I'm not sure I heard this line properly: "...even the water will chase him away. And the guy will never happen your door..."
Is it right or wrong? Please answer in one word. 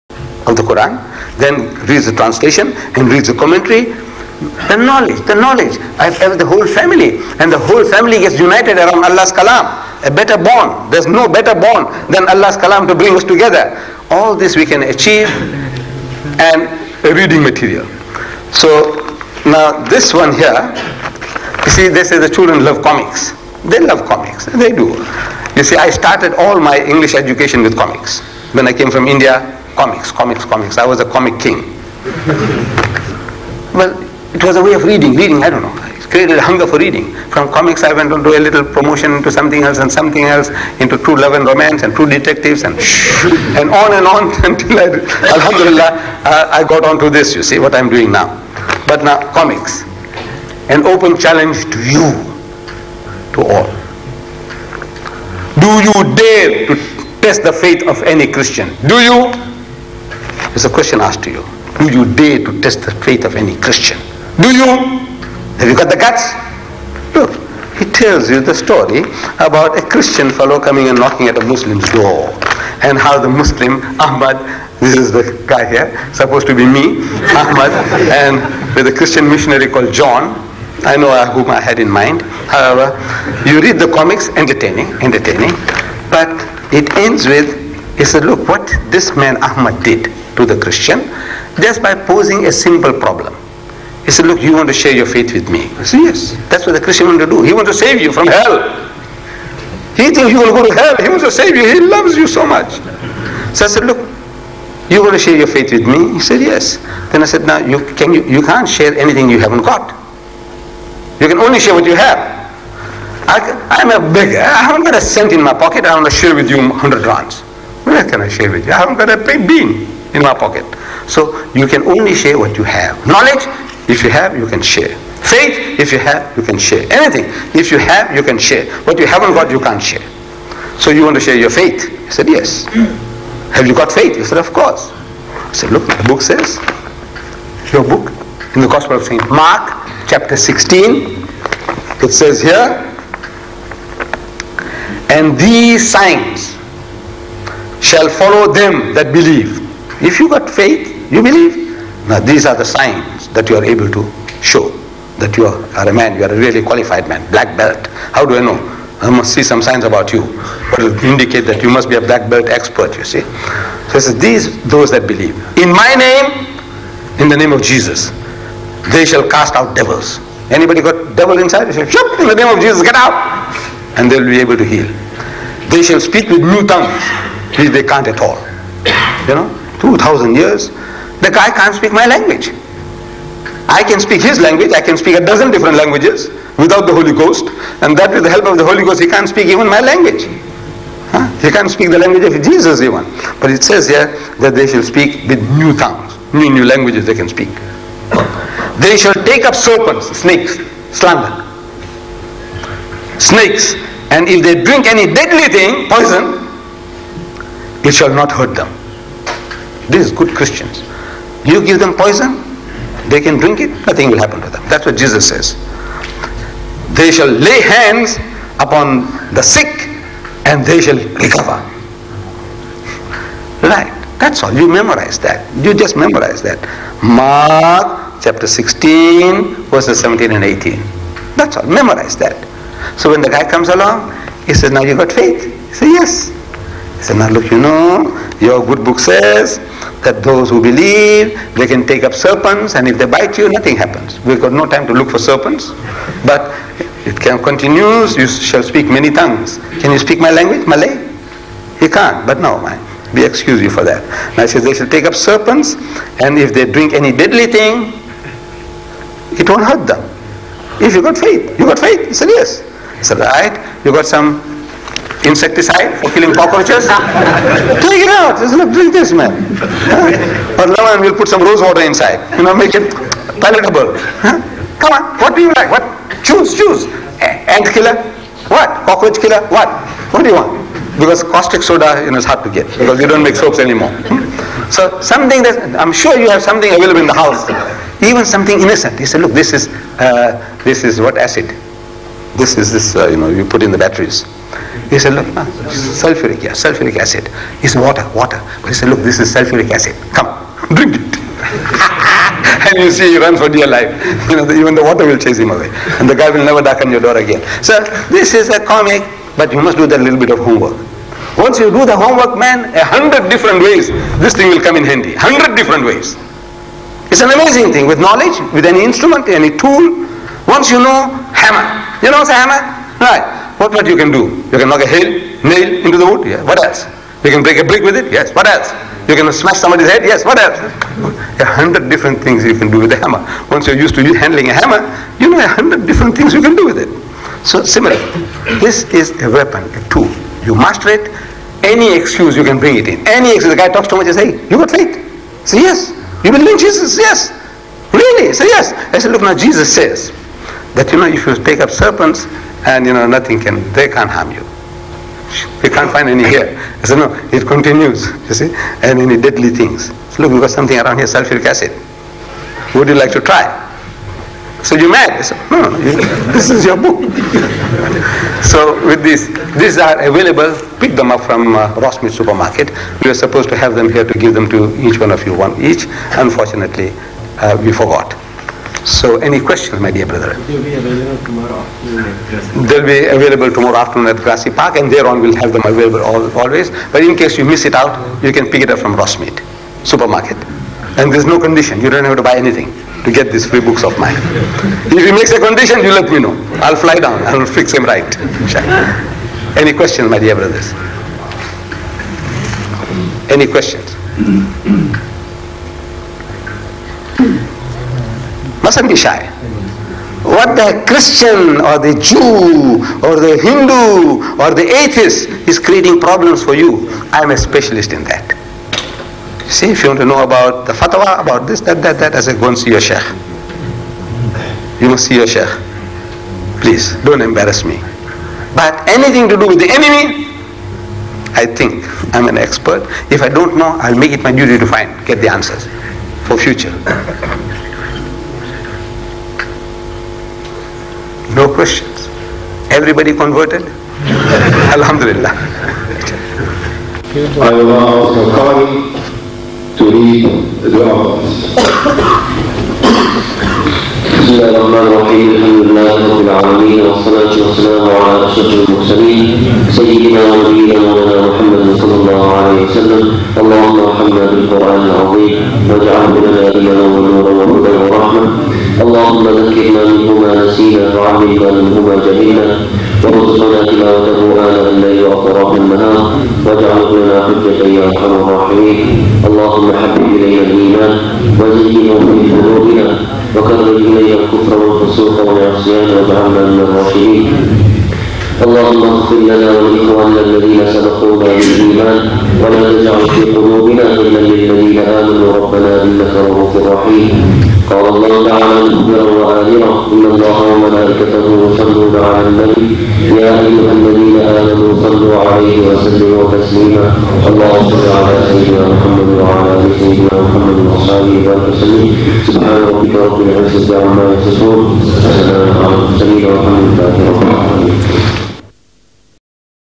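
wrong.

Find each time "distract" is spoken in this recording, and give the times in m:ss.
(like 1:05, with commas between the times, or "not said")
not said.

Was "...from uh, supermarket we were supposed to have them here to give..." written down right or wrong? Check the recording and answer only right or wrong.
right.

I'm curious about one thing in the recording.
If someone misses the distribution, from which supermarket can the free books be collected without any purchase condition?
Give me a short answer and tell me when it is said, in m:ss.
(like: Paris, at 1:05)
Rossmead supermarket, at 6:28.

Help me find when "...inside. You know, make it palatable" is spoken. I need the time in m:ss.
4:31.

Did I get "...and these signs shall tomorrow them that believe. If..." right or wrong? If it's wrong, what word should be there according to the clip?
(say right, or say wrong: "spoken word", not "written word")
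wrong: "follow", not "tomorrow".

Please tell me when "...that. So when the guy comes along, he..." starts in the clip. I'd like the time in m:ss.
3:52.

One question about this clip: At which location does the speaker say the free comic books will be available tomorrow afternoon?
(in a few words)
Grassy Park.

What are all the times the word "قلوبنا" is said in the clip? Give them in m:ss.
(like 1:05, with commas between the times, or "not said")
8:02, 8:13.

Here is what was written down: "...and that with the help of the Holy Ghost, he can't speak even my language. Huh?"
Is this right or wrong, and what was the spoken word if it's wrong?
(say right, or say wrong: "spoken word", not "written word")
right.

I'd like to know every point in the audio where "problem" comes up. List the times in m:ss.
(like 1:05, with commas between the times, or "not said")
1:32, 6:55.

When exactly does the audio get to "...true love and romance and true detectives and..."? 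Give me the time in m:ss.
0:40.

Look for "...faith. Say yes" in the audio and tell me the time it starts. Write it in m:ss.
5:44.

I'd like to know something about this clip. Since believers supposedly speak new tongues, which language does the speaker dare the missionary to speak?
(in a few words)
Malay.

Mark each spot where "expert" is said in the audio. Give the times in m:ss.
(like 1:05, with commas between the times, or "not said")
2:42, 7:12.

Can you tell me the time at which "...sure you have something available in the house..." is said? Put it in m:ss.
4:45.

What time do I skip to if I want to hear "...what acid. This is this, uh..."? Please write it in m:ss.
4:50.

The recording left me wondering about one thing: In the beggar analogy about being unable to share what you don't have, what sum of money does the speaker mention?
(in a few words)
100 rands.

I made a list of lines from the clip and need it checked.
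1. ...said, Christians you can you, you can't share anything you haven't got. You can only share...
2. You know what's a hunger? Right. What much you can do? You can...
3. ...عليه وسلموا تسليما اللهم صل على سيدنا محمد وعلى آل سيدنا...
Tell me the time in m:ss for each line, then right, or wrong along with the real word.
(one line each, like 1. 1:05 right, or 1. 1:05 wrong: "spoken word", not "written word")
1. 1:47 wrong: "Now", not "Christians"
2. 5:22 wrong: "hammer", not "hunger"
3. 8:25 right.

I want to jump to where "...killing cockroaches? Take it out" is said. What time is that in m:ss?
4:26.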